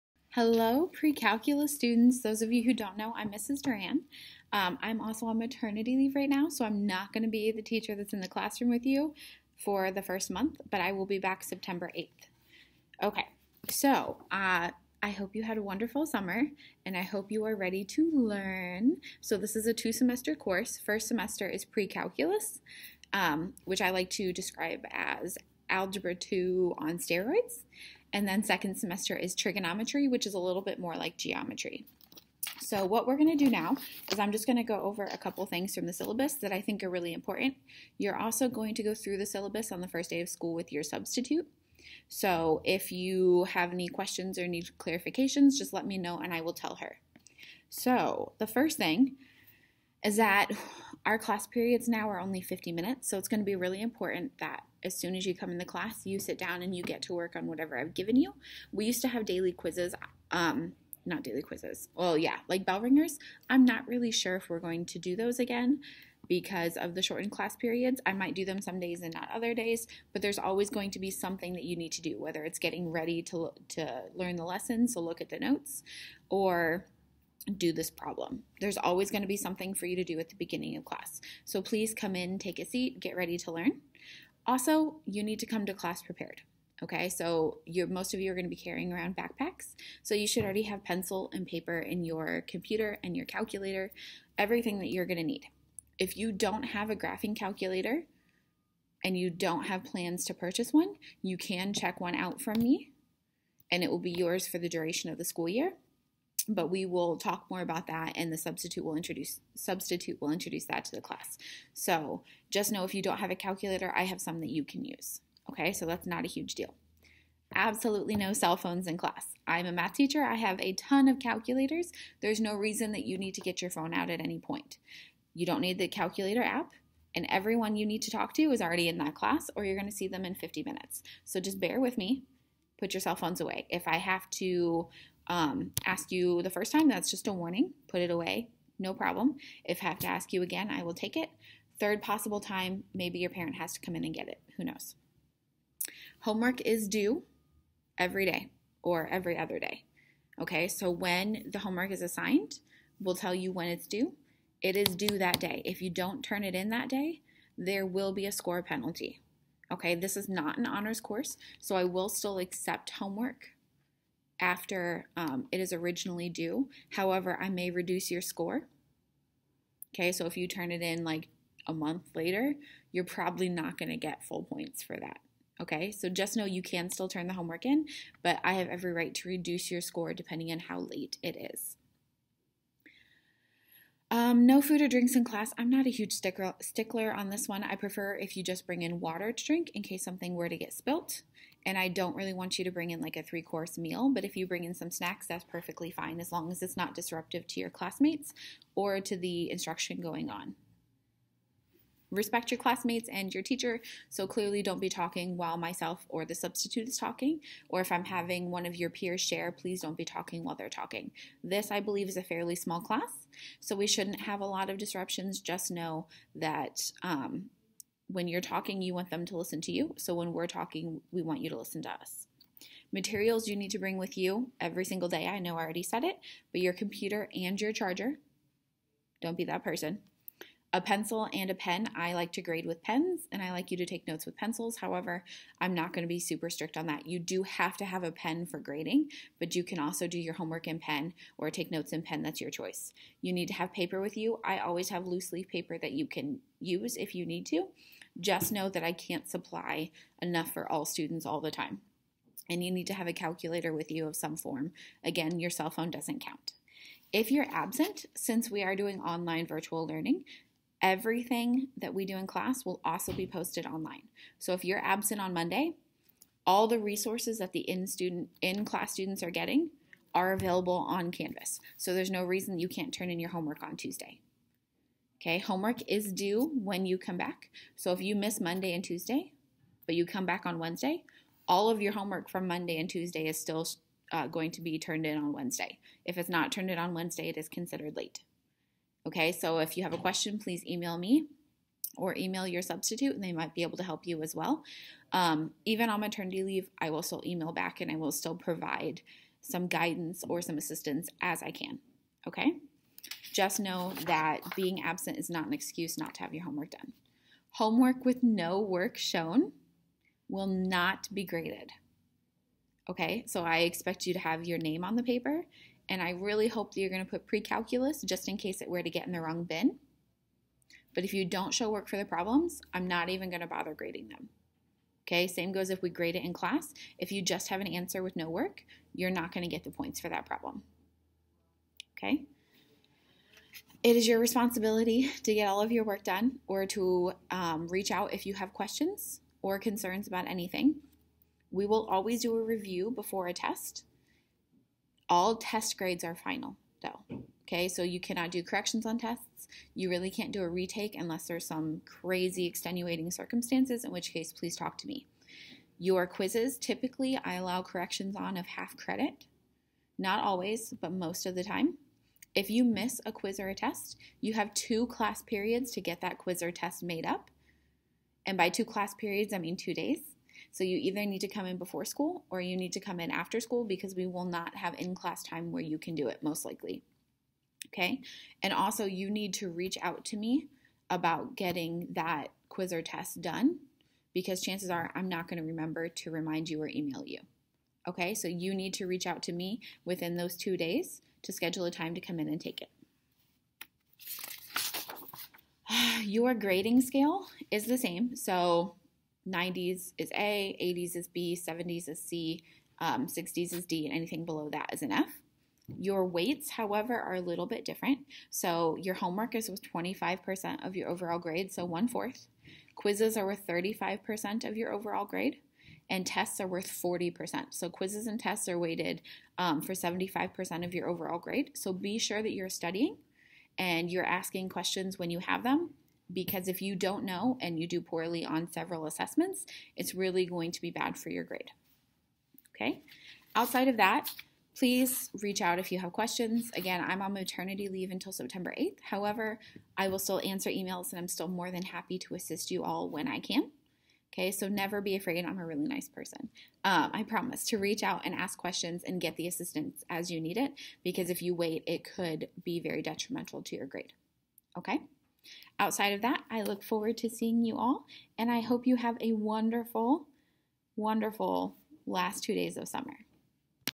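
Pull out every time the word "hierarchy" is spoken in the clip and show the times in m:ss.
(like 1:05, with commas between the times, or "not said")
not said.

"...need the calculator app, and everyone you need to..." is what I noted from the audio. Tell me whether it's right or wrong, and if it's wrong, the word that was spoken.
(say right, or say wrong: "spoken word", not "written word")
right.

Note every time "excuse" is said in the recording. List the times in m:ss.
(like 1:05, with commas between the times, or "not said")
5:05.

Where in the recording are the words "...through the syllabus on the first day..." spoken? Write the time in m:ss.
0:38.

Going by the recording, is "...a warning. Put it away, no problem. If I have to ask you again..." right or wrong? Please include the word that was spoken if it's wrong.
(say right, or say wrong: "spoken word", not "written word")
right.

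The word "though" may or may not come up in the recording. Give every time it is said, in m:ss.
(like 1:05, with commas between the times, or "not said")
5:46.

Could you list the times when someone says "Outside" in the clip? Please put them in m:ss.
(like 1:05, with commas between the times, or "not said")
7:13, 7:35.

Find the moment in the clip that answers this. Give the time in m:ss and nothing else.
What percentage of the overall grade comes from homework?
6:49.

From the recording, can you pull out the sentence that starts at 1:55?
Okay, so that's not a huge deal.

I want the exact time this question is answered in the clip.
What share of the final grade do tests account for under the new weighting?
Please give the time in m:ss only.
6:56.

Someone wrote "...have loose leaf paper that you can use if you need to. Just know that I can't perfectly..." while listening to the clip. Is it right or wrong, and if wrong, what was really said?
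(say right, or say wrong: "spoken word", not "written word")
wrong: "supply", not "perfectly".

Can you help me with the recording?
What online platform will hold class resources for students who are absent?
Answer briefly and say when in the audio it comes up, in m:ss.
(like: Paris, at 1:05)
Canvas, at 4:31.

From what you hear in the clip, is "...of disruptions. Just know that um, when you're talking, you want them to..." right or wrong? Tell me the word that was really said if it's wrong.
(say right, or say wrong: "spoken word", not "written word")
right.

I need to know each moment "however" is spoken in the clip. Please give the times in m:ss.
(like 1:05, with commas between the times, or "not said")
2:46, 3:54, 6:46, 7:18.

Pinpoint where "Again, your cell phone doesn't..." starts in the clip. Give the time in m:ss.
4:15.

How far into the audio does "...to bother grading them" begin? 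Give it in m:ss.
5:23.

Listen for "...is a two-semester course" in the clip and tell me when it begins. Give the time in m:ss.
0:19.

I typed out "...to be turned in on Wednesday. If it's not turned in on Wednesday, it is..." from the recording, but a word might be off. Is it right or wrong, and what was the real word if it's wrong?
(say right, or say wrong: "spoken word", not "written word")
right.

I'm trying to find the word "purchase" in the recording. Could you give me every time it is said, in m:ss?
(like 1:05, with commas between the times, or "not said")
1:40.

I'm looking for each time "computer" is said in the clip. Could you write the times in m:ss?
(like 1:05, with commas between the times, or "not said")
1:32, 3:46.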